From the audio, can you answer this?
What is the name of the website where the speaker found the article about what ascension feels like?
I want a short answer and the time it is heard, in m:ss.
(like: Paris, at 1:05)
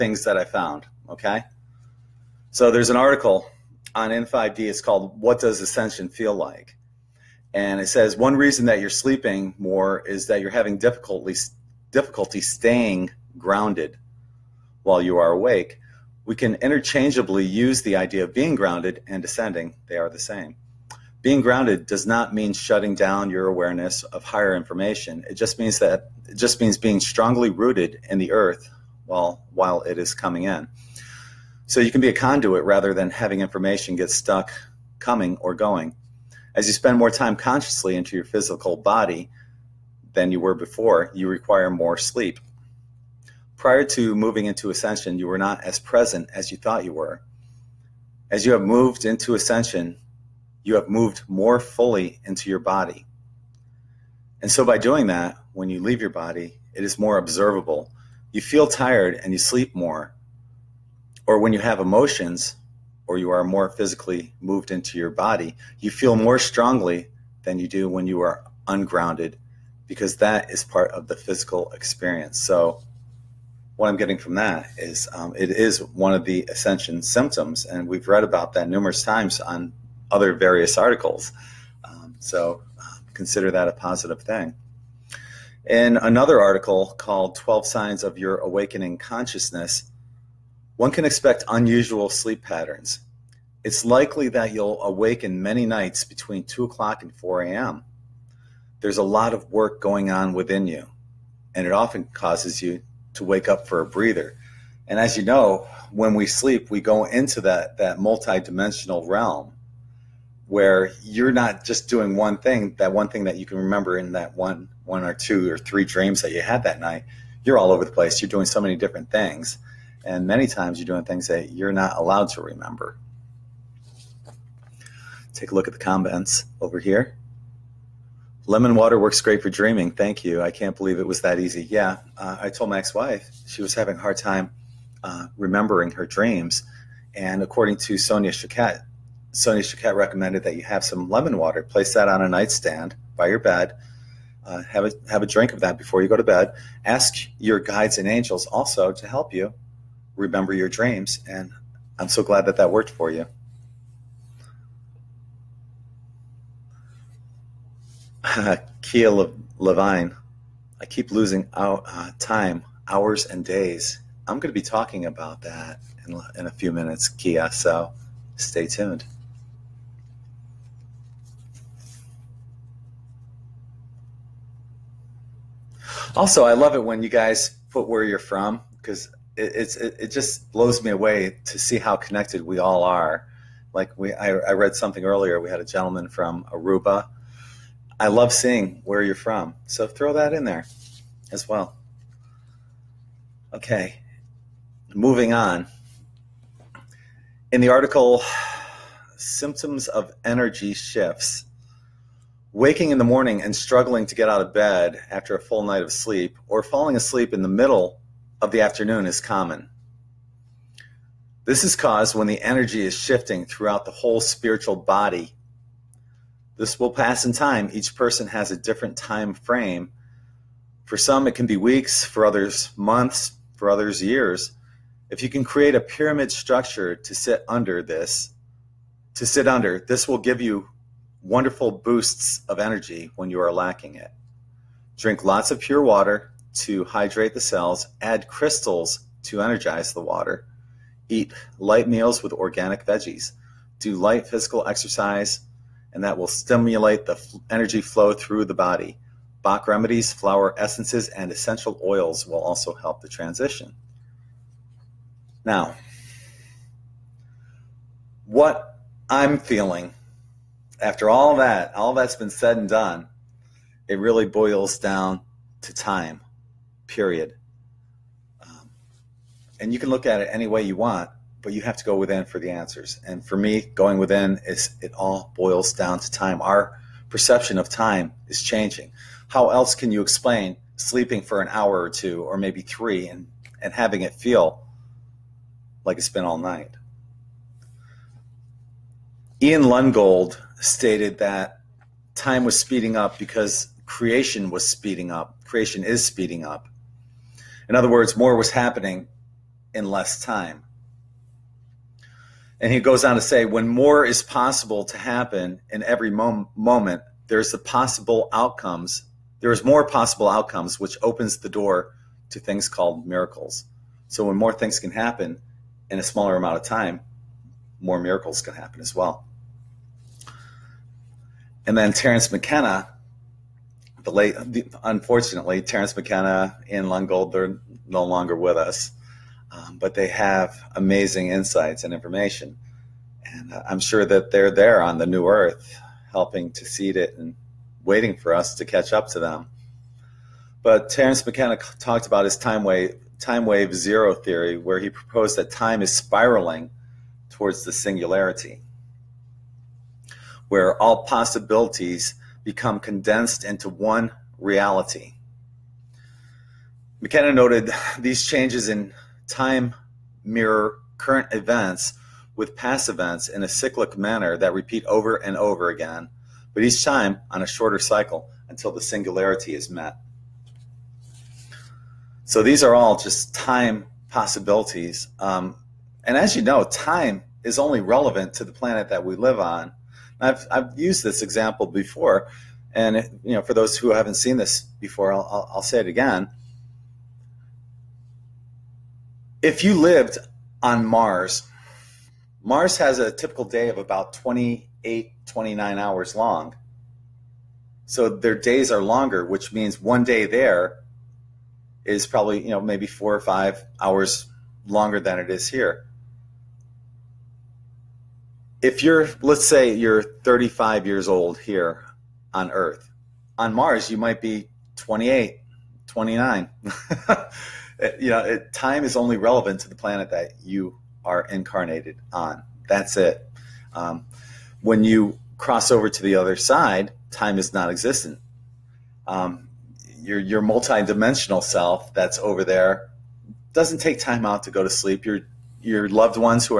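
In5D, at 0:04.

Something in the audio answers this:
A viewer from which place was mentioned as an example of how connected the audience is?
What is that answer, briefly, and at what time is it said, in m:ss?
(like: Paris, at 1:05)
Aruba, at 3:06.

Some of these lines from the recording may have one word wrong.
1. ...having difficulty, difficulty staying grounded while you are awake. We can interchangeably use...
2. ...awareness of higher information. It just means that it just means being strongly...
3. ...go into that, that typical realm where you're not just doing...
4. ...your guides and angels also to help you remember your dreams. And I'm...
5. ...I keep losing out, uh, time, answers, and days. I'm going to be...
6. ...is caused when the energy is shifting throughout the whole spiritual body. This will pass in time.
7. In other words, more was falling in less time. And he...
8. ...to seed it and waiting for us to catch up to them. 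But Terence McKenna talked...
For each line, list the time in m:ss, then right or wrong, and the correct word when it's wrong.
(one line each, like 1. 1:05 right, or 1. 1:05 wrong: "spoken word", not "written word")
1. 0:10 right
2. 0:23 right
3. 1:46 wrong: "multidimensional", not "typical"
4. 2:27 right
5. 2:40 wrong: "hours", not "answers"
6. 3:31 right
7. 4:57 wrong: "happening", not "falling"
8. 5:36 right.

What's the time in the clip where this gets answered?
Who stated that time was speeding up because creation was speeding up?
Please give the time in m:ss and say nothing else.
4:49.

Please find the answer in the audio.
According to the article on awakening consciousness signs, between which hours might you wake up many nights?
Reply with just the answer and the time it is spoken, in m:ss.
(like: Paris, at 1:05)
2 to 4 a.m., at 1:36.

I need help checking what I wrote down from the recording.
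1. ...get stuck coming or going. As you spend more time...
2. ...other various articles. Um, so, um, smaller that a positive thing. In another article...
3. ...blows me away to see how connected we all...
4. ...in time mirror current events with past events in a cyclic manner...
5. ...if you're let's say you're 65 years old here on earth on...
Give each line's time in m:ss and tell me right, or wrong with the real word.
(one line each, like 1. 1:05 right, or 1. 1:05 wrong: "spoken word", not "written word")
1. 0:33 right
2. 1:20 wrong: "consider", not "smaller"
3. 3:00 right
4. 5:58 right
5. 6:48 wrong: "35", not "65".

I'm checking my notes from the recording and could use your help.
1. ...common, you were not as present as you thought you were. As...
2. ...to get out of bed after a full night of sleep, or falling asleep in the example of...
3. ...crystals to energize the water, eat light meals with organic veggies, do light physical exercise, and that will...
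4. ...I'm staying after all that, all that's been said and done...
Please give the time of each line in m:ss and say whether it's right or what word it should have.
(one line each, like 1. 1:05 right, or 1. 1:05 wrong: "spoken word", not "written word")
1. 0:44 wrong: "ascension", not "common"
2. 3:24 wrong: "middle", not "example"
3. 3:58 right
4. 4:19 wrong: "feeling", not "staying".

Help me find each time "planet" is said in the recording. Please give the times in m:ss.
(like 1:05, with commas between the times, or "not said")
6:18, 6:59.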